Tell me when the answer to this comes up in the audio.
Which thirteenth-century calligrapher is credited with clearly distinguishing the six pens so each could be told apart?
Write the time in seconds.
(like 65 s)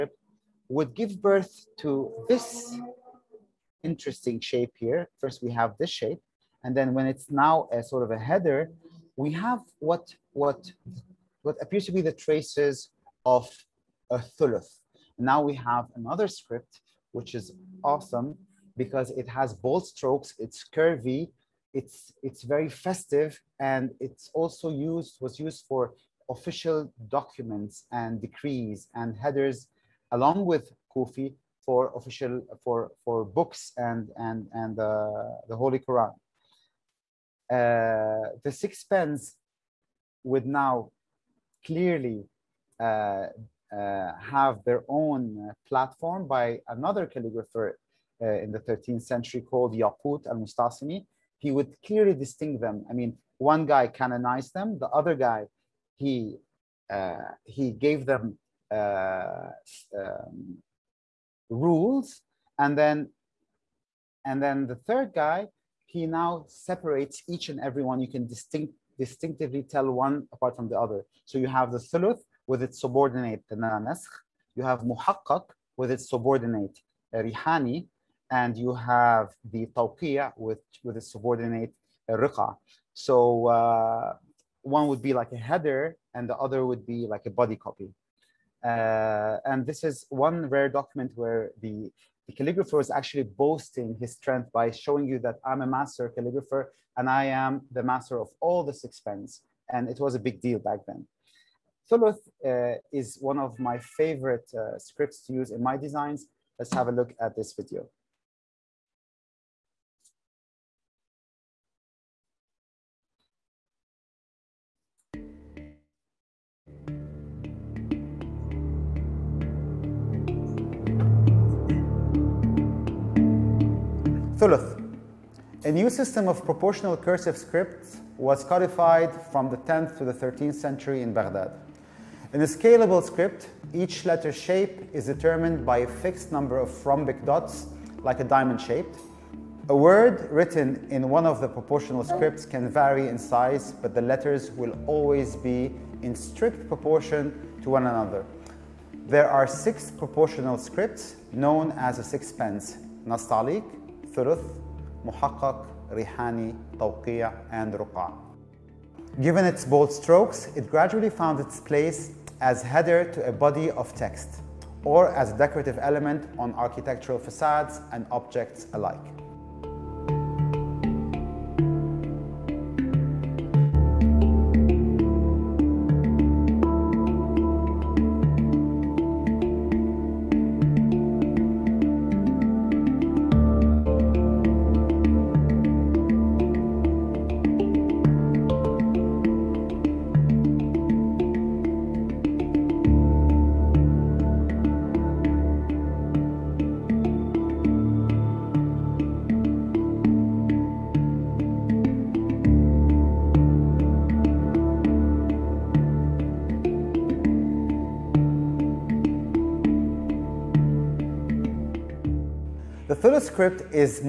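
49 s.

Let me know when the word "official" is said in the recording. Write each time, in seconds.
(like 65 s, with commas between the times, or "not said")
26 s, 31 s.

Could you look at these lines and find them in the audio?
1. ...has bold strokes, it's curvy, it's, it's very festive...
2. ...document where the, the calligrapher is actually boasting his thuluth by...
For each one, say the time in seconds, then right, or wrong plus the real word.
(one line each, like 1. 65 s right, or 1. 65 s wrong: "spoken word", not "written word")
1. 19 s right
2. 90 s wrong: "strength", not "thuluth".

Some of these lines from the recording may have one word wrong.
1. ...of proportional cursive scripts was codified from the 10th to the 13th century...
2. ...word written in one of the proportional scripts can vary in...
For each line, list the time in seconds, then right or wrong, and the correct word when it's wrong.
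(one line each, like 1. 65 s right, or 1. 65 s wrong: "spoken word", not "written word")
1. 126 s right
2. 139 s right.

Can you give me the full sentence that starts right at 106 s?
Let's have a look at this video.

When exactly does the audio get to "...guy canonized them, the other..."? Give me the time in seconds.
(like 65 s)
53 s.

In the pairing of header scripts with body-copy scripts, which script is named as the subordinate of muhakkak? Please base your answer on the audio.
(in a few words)
Rihani.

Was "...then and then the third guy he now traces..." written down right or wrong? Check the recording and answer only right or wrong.
wrong.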